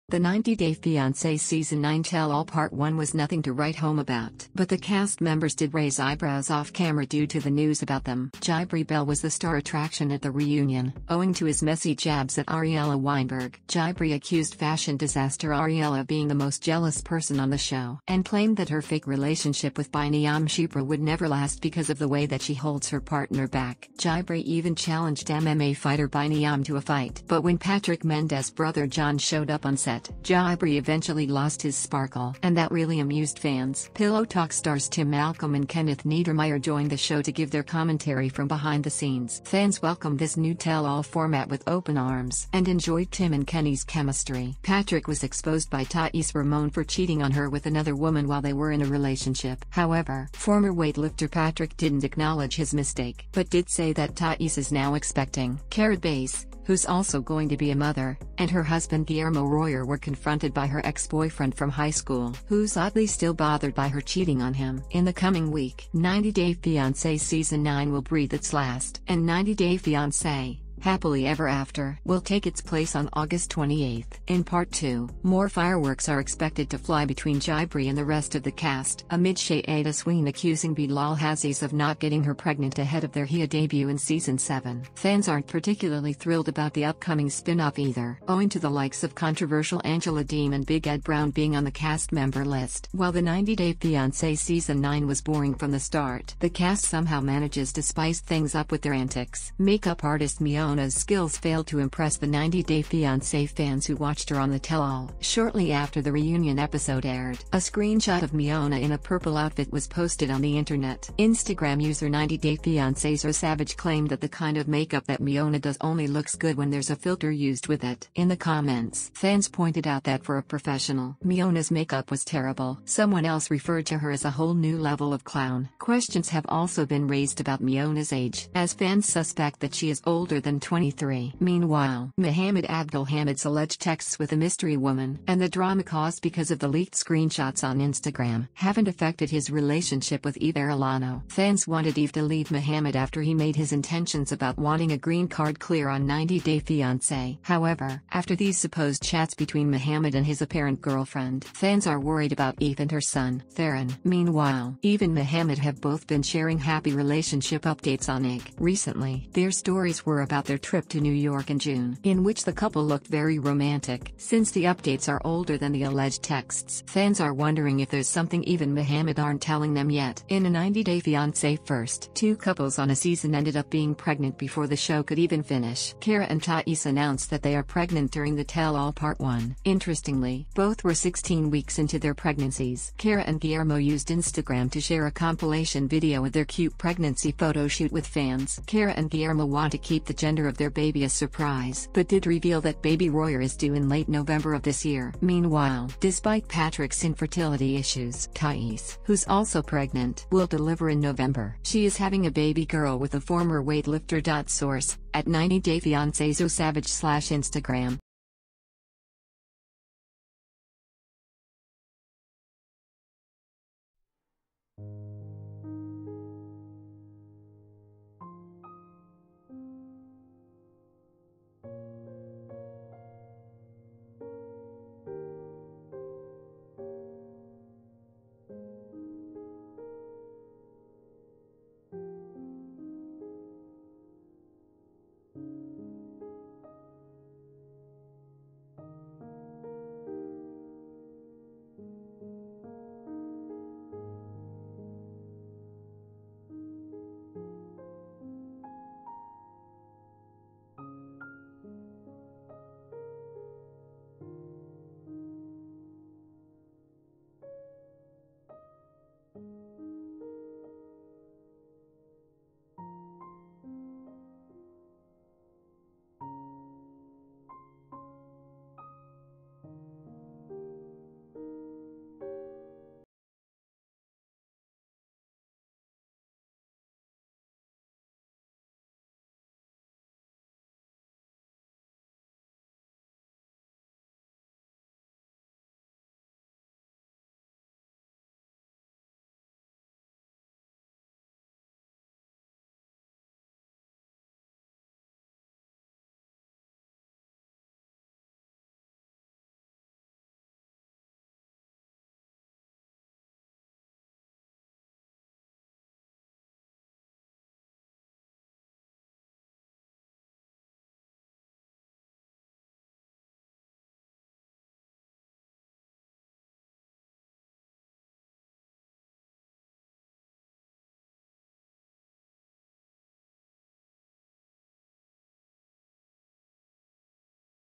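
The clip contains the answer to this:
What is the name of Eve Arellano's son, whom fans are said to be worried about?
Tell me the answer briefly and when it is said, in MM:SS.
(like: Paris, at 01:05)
Theron, at 02:33.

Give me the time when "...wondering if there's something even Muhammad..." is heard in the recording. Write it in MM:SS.
02:47.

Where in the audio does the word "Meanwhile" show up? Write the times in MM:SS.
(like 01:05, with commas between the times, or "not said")
02:11, 02:34, 03:15.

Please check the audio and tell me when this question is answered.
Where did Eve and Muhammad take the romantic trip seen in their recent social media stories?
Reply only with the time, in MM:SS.
02:40.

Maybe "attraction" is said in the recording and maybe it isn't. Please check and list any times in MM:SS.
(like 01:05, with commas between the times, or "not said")
00:09.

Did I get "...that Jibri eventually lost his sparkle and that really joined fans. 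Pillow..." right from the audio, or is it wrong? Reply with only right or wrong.
wrong.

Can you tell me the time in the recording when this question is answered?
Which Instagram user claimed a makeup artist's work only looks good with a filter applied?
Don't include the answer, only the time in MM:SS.
01:52.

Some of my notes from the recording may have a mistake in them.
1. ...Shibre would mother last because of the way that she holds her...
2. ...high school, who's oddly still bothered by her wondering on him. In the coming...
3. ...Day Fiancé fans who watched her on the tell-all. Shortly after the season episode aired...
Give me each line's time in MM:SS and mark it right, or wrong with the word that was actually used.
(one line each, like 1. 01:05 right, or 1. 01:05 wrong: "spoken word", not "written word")
1. 00:20 wrong: "never", not "mother"
2. 01:01 wrong: "cheating", not "wondering"
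3. 01:42 wrong: "reunion", not "season".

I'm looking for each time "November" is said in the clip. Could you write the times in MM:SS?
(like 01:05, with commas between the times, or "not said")
03:14, 03:20.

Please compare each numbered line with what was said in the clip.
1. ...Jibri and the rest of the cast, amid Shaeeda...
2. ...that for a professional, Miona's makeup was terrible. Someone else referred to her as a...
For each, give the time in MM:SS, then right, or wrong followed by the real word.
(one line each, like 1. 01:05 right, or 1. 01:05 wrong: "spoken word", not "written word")
1. 01:17 right
2. 02:00 right.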